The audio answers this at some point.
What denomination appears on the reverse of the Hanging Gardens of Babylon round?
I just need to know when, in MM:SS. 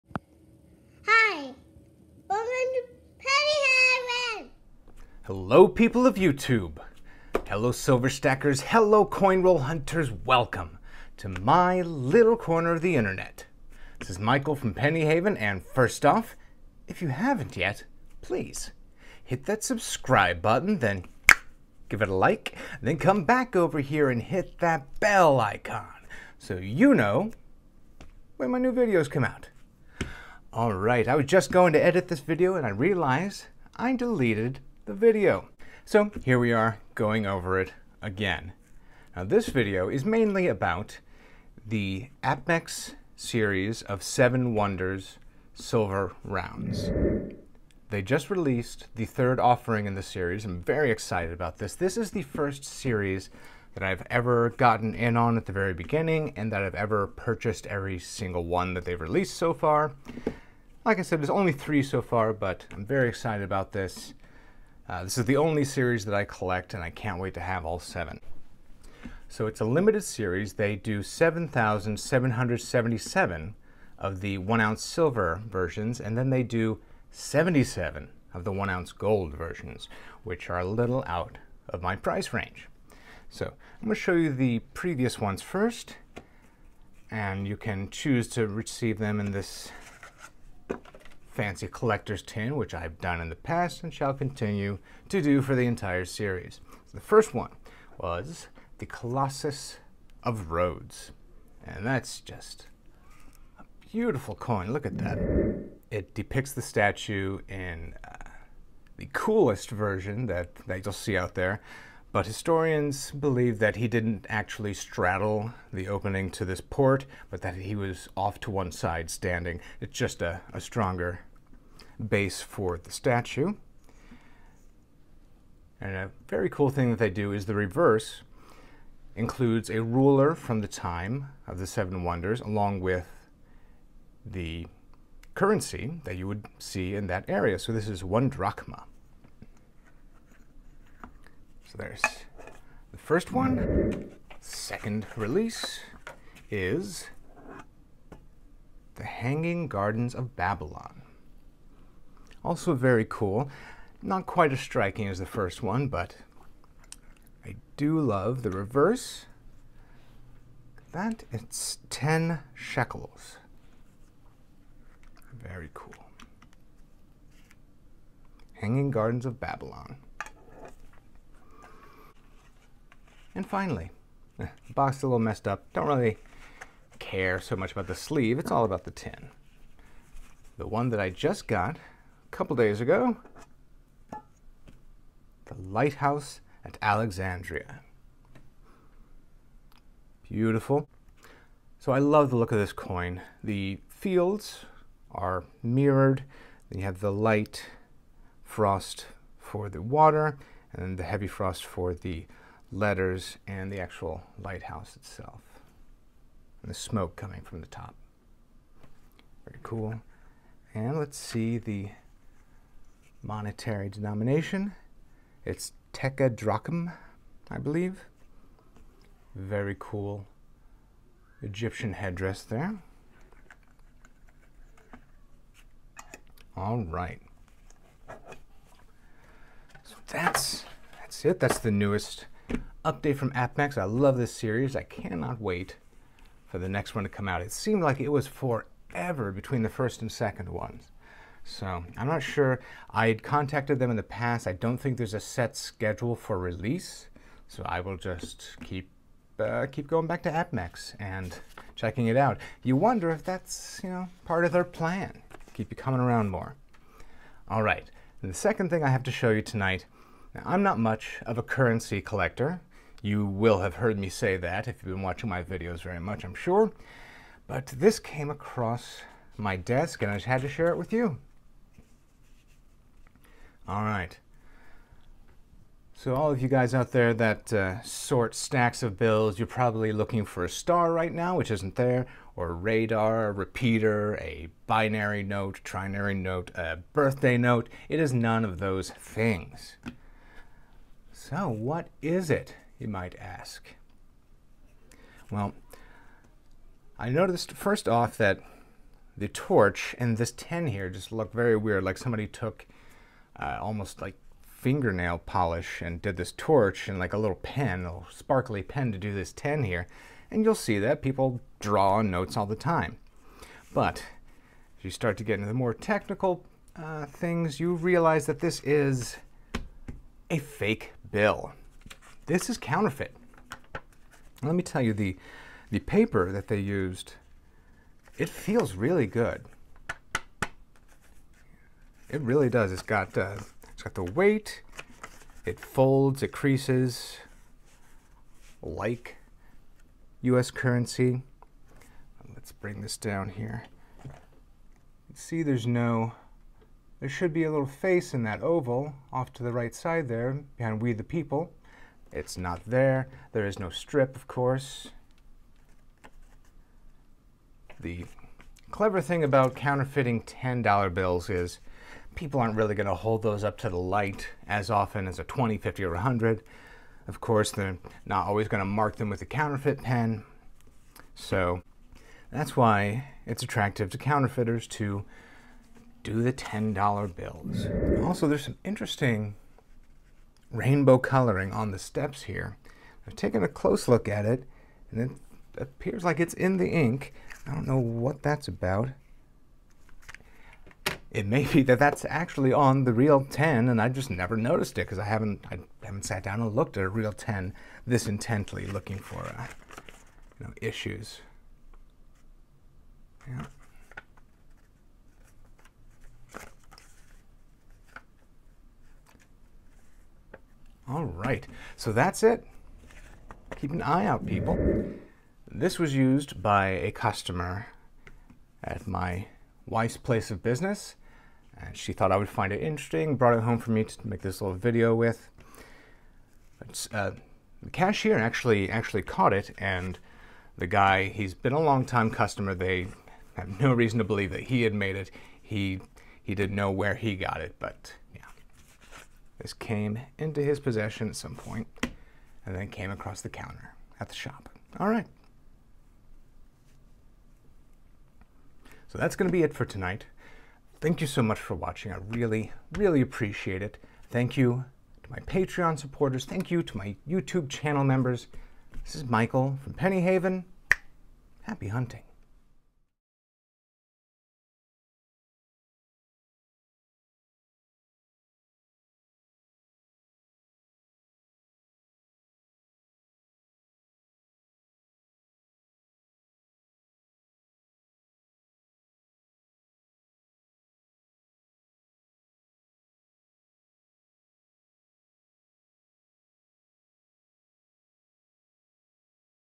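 02:41.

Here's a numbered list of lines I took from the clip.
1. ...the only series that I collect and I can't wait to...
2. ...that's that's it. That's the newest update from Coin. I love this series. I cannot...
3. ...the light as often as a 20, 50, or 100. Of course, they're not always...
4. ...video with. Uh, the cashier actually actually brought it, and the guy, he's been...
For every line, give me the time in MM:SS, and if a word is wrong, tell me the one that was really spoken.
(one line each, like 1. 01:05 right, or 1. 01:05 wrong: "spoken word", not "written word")
1. 01:05 right
2. 03:50 wrong: "Apmex", not "Coin"
3. 06:03 right
4. 07:04 wrong: "caught", not "brought".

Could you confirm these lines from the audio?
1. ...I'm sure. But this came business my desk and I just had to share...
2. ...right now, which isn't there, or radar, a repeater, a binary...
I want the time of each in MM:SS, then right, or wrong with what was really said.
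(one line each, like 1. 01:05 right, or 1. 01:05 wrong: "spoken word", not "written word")
1. 04:26 wrong: "across", not "business"
2. 04:40 right.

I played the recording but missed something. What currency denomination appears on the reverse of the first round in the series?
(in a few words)
one drachma.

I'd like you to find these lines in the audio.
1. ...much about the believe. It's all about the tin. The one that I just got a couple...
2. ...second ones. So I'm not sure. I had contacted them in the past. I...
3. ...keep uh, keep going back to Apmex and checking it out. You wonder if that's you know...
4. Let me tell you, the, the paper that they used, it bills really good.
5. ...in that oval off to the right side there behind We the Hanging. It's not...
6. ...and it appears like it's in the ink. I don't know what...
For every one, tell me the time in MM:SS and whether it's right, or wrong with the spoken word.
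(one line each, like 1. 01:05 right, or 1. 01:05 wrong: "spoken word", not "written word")
1. 02:57 wrong: "sleeve", not "believe"
2. 04:00 right
3. 04:08 right
4. 05:24 wrong: "feels", not "bills"
5. 05:48 wrong: "People", not "Hanging"
6. 06:24 right.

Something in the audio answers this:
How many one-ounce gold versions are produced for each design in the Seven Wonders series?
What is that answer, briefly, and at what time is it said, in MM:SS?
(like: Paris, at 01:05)
77, at 01:17.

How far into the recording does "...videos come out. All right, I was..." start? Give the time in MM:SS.
00:28.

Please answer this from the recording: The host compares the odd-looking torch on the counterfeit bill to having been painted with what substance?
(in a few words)
fingernail polish.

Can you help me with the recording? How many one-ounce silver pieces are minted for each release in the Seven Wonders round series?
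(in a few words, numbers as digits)
7,777.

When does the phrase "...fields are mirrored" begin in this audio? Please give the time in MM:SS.
03:13.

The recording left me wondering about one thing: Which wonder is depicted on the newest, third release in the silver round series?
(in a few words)
Lighthouse at Alexandria.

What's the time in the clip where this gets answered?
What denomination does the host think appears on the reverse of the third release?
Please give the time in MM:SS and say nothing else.
03:35.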